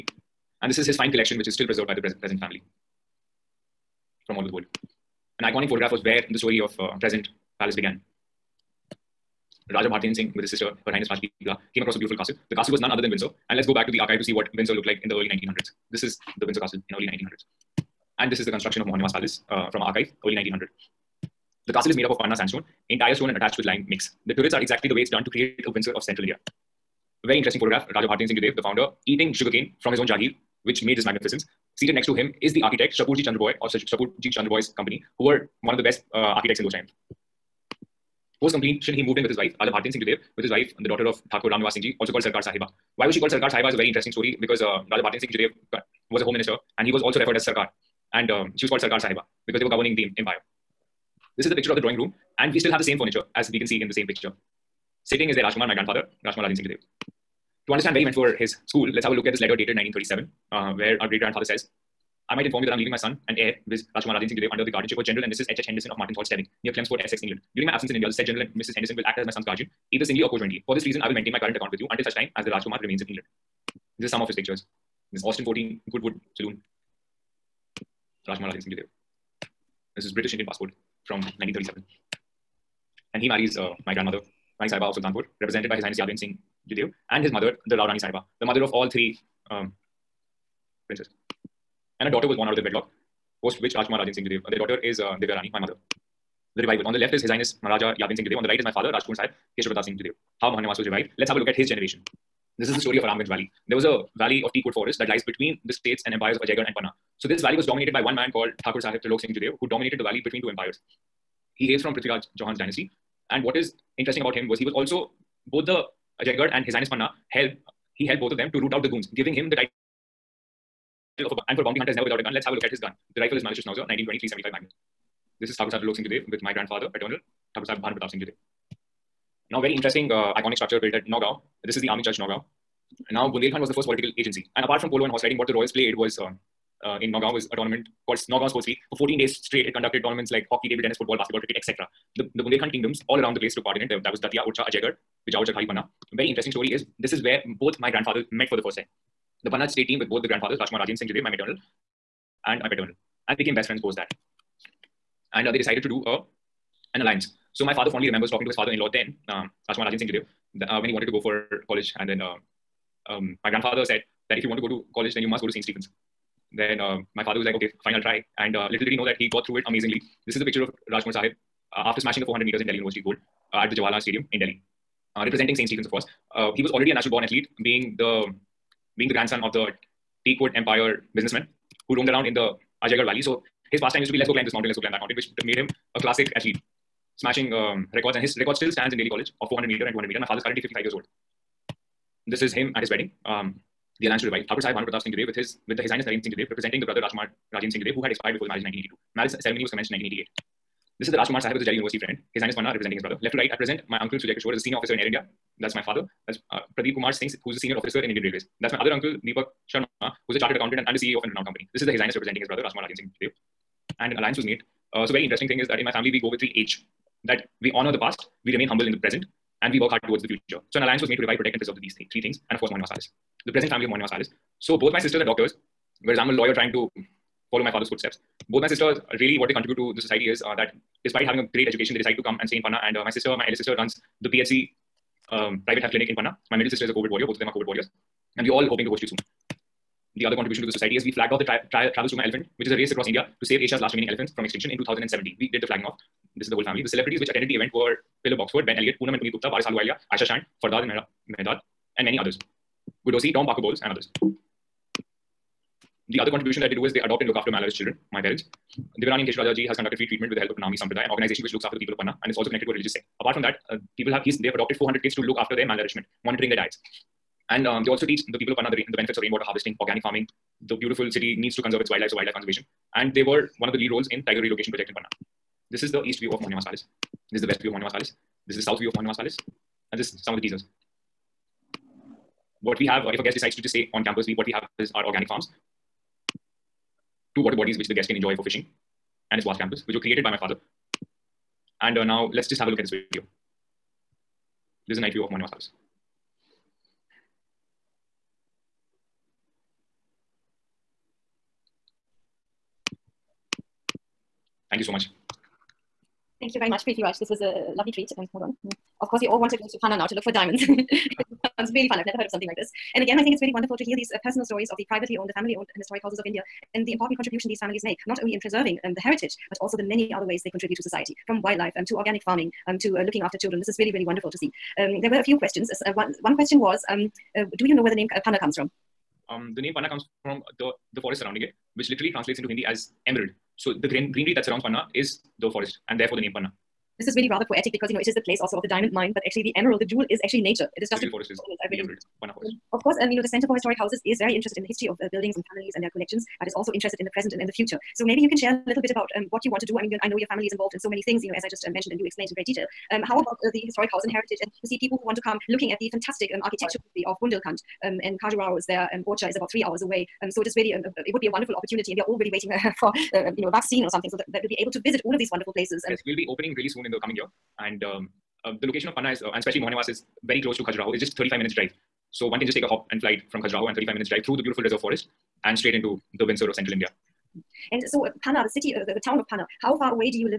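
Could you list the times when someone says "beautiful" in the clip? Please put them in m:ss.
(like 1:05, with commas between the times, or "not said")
0:11, 4:30, 6:14.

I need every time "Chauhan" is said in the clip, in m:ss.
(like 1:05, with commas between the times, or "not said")
1:52.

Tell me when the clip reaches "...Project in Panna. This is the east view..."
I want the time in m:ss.
4:34.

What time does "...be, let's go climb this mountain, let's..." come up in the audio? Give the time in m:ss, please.
3:04.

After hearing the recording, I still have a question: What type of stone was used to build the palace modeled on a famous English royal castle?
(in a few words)
Panna sandstone.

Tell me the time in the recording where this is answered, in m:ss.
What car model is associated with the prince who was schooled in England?
1:15.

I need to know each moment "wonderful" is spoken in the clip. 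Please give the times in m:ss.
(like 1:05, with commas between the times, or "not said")
5:13, 5:24, 6:01, 6:05.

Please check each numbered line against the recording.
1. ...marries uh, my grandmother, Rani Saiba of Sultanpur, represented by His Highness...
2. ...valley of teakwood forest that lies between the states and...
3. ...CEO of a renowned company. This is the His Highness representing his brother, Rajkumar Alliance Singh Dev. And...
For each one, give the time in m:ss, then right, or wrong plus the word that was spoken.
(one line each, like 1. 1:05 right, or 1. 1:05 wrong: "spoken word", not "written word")
1. 1:23 right
2. 1:44 right
3. 3:30 wrong: "Rajan", not "Alliance".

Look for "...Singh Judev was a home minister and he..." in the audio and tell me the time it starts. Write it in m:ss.
0:45.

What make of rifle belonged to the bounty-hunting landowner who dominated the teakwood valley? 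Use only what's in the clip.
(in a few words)
Mannlicher Schönauer.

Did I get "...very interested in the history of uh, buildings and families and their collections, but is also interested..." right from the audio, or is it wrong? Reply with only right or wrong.
right.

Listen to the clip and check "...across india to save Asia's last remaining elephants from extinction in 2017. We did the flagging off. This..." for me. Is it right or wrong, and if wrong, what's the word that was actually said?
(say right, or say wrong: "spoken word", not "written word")
right.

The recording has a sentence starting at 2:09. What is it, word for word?
Now, very interesting uh, iconic structure built at Nagaon.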